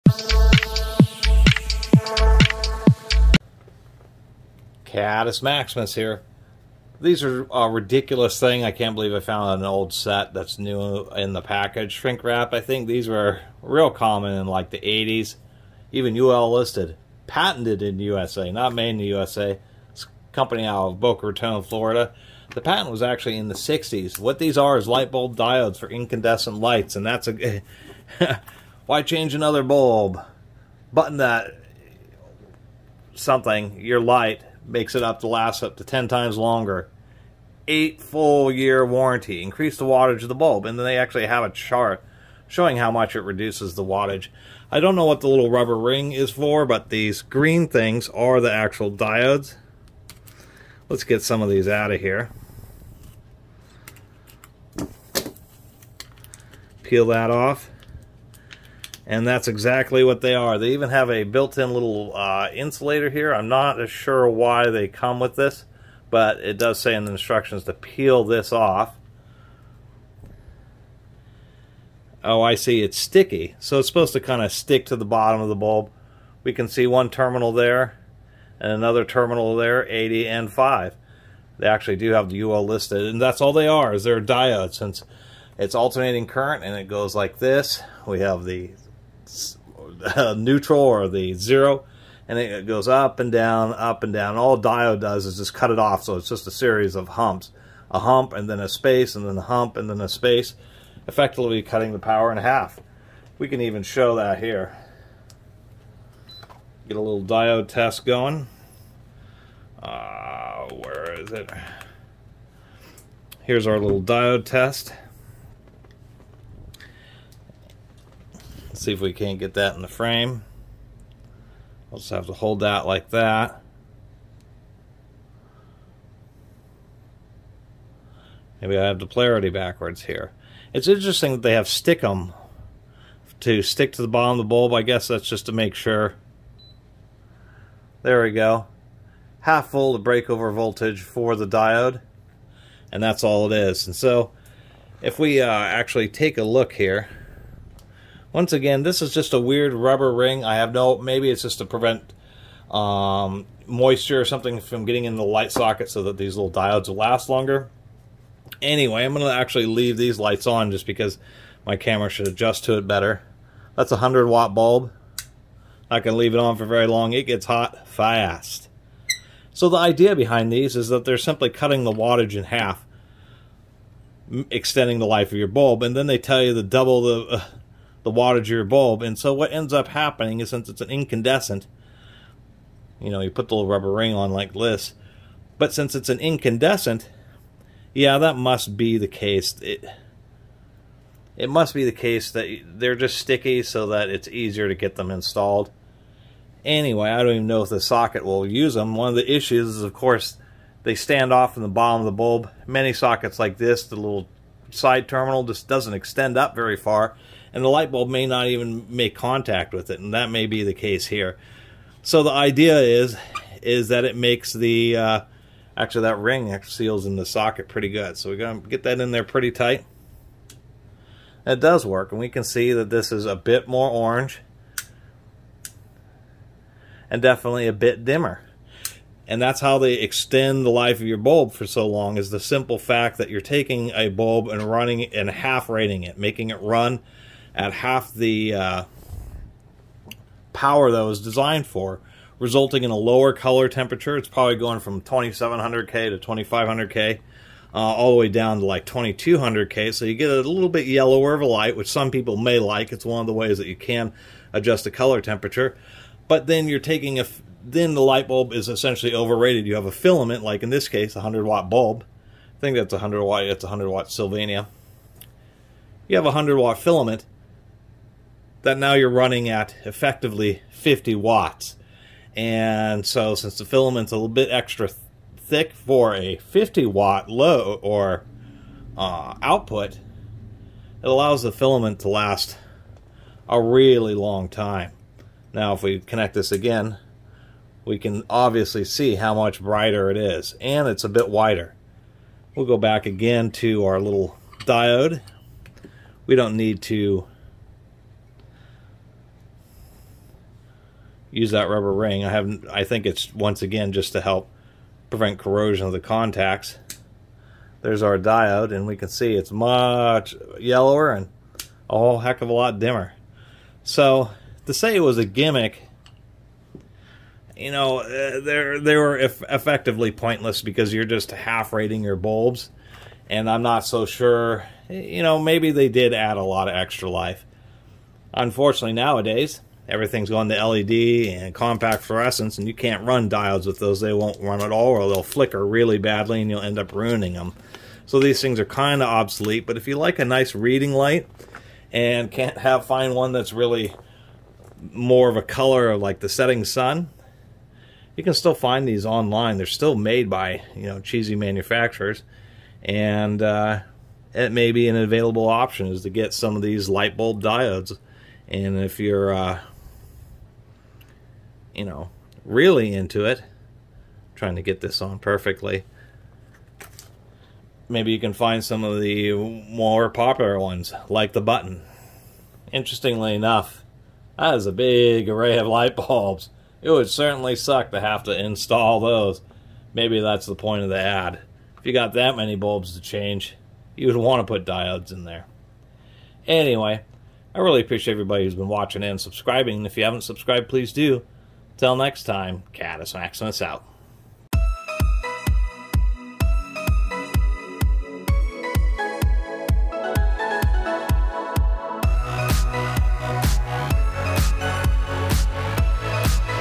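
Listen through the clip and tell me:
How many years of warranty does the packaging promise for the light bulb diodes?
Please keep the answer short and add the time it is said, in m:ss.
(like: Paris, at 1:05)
8, at 0:37.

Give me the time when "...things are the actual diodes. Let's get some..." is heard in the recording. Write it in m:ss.
0:47.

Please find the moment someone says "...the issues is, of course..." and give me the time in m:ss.
3:19.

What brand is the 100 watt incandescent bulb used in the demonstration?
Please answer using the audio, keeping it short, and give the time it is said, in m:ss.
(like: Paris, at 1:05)
Sylvania, at 4:24.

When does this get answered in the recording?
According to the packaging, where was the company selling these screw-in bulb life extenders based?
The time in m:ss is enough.
0:20.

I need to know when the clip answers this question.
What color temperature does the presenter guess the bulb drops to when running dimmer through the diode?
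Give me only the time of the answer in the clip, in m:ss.
4:08.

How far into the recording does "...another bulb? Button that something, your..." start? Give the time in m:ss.
0:29.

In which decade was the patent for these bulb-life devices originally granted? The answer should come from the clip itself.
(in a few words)
1960s.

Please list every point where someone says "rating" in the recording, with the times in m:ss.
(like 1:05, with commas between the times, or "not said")
3:55, 5:21.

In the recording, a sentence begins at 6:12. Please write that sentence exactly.
Interestingly enough, that is a big array of light bulbs.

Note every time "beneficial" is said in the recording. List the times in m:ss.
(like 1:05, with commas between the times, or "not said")
not said.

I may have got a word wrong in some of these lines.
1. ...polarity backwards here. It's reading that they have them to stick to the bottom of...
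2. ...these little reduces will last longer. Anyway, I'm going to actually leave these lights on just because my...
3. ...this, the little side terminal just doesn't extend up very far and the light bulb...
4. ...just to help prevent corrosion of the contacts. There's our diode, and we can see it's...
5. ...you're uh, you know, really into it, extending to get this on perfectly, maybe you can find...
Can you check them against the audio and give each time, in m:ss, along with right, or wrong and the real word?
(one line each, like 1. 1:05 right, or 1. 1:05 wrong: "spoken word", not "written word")
1. 2:09 wrong: "interesting", not "reading"
2. 2:36 wrong: "diodes", not "reduces"
3. 3:23 right
4. 5:03 right
5. 5:58 wrong: "trying", not "extending".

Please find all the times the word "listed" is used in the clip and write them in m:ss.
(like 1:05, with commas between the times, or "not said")
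0:16, 1:22.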